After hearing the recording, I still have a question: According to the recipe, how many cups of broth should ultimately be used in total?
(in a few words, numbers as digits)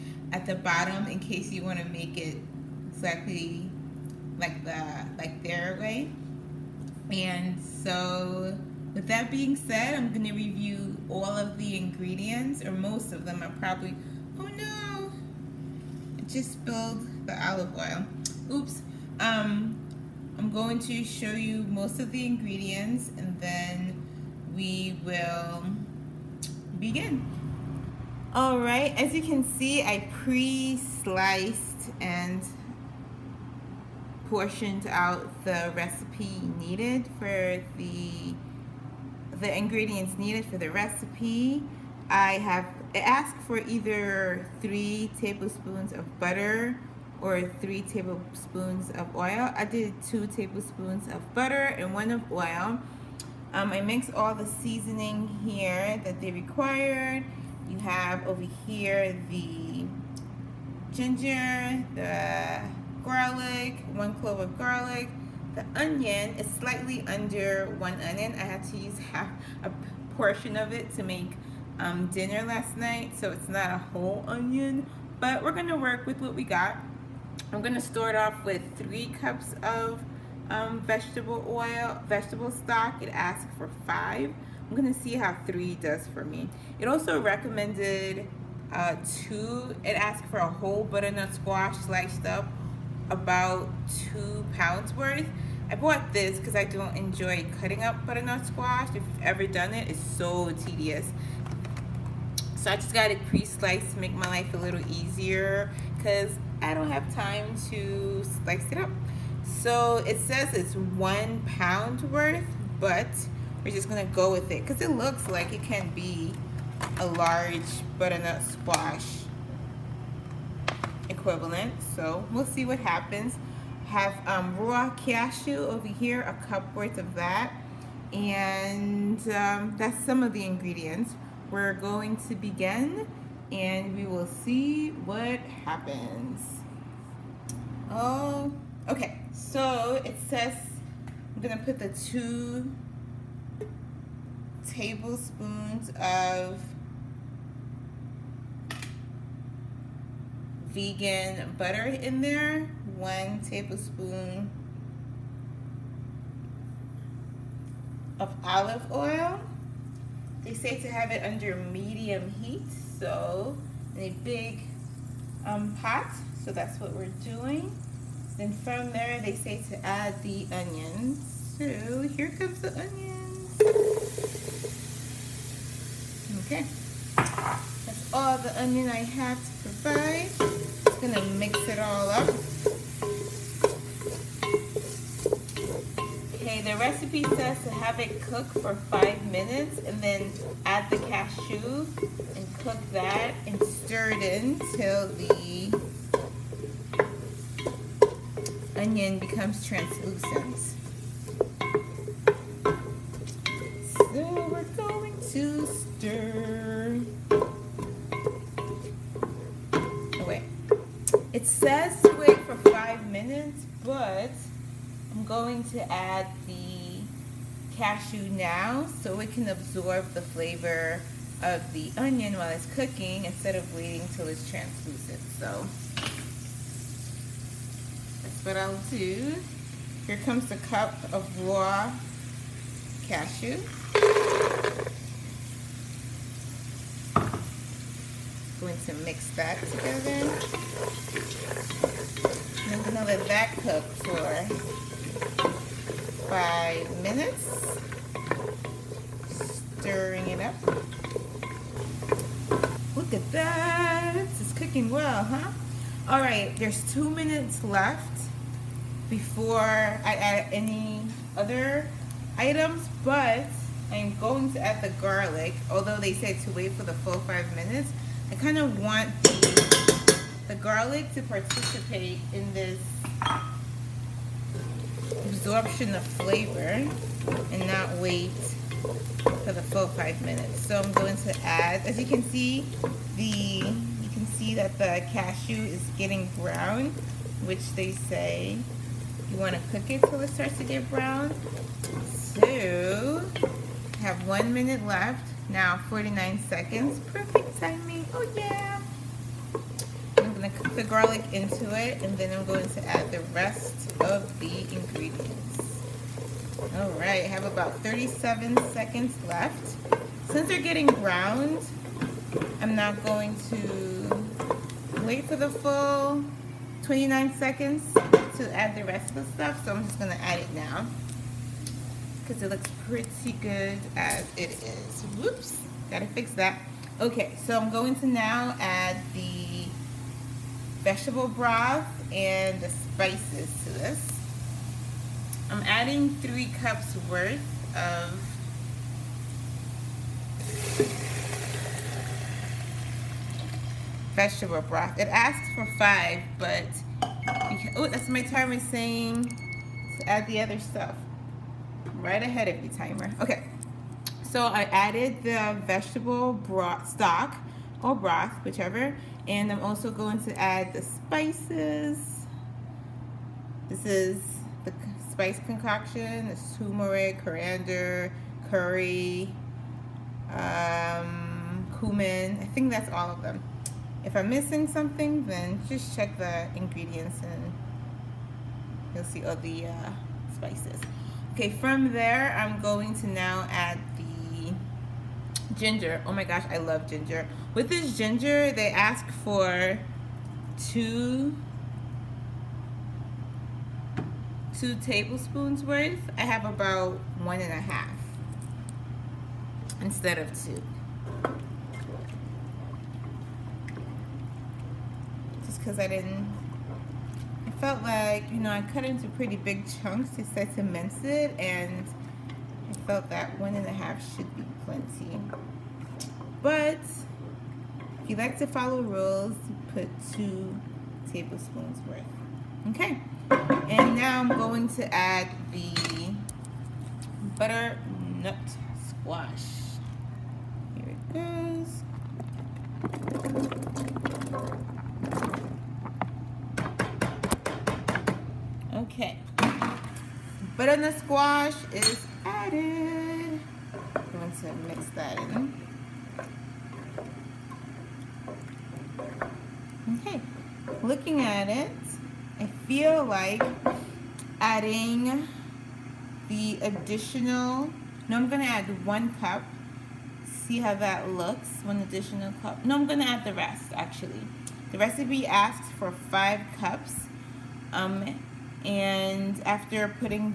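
5 cups.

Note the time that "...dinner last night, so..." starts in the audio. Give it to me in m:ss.
1:12.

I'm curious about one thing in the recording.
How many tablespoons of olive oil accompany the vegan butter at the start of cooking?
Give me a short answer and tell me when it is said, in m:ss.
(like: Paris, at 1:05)
1, at 2:32.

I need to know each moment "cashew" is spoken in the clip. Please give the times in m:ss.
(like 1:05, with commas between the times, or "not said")
2:04, 3:10, 3:37, 3:53, 4:45.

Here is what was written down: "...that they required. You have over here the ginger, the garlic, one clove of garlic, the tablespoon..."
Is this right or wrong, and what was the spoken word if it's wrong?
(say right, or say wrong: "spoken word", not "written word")
wrong: "onion", not "tablespoon".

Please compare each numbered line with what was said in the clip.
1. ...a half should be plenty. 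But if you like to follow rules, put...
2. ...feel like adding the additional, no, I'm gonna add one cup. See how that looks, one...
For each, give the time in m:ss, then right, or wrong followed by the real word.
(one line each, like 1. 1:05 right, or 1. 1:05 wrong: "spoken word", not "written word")
1. 6:53 right
2. 7:32 right.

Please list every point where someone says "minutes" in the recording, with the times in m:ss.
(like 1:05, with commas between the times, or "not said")
3:09, 3:33, 4:07, 4:17, 4:27, 4:40, 4:54.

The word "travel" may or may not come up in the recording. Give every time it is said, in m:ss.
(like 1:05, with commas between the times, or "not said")
not said.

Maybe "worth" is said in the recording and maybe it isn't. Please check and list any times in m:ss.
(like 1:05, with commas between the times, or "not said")
1:34, 1:52, 2:06, 5:37, 6:35, 7:01.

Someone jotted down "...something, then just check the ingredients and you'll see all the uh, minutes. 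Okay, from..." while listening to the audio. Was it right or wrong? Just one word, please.
wrong.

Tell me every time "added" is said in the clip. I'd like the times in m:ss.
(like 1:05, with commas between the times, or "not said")
5:54, 7:22.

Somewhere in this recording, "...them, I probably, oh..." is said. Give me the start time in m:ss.
0:13.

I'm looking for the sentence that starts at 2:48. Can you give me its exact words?
Then from there, they say to add the onions.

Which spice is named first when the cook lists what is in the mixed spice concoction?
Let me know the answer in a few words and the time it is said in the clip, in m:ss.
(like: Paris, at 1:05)
turmeric, at 6:06.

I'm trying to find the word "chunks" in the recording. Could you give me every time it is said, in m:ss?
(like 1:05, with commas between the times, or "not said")
6:49.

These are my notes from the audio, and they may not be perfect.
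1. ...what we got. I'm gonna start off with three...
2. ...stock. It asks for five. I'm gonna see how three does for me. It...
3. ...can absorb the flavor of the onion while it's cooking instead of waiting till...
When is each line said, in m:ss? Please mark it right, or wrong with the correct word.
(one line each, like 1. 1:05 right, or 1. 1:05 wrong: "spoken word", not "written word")
1. 1:16 right
2. 1:22 right
3. 3:39 right.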